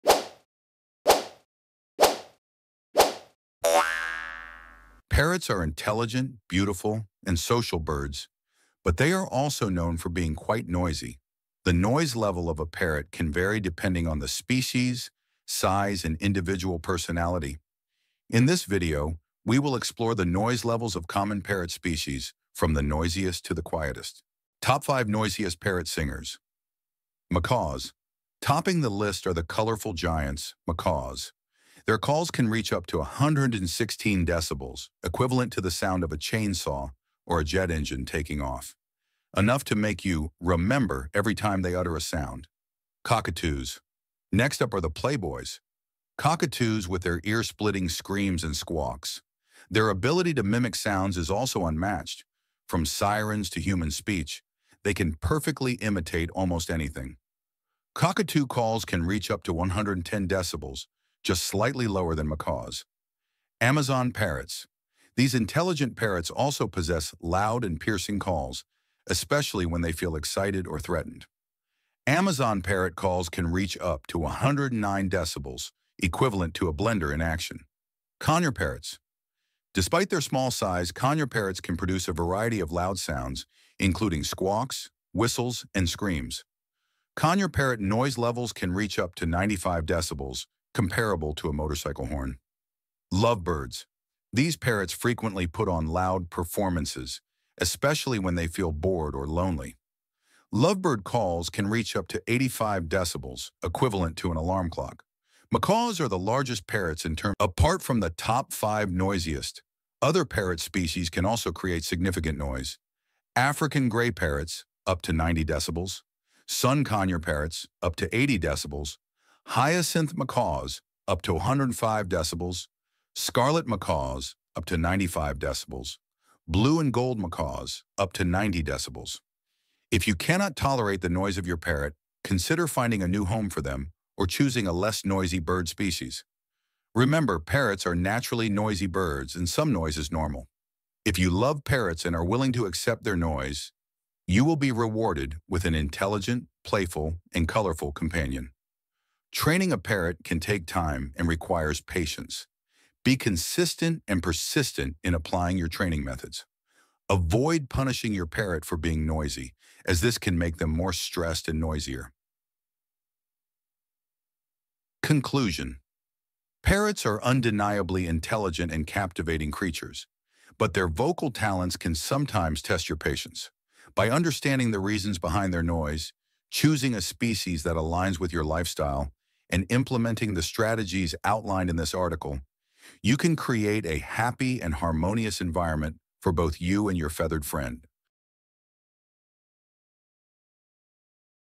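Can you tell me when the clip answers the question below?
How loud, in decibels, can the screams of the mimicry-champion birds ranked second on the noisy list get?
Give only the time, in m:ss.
0:59.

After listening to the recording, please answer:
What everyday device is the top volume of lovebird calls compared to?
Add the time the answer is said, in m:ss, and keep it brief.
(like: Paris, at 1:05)
an alarm clock, at 1:44.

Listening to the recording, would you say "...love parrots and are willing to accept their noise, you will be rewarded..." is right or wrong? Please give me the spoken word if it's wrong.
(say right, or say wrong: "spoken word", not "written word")
right.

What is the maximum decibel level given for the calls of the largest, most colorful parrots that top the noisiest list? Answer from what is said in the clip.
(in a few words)
116 decibels.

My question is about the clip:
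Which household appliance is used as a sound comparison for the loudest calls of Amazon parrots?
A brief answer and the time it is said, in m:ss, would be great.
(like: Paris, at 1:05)
a blender, at 1:16.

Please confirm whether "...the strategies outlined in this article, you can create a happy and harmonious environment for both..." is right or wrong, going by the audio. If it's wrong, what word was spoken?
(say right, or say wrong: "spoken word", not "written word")
right.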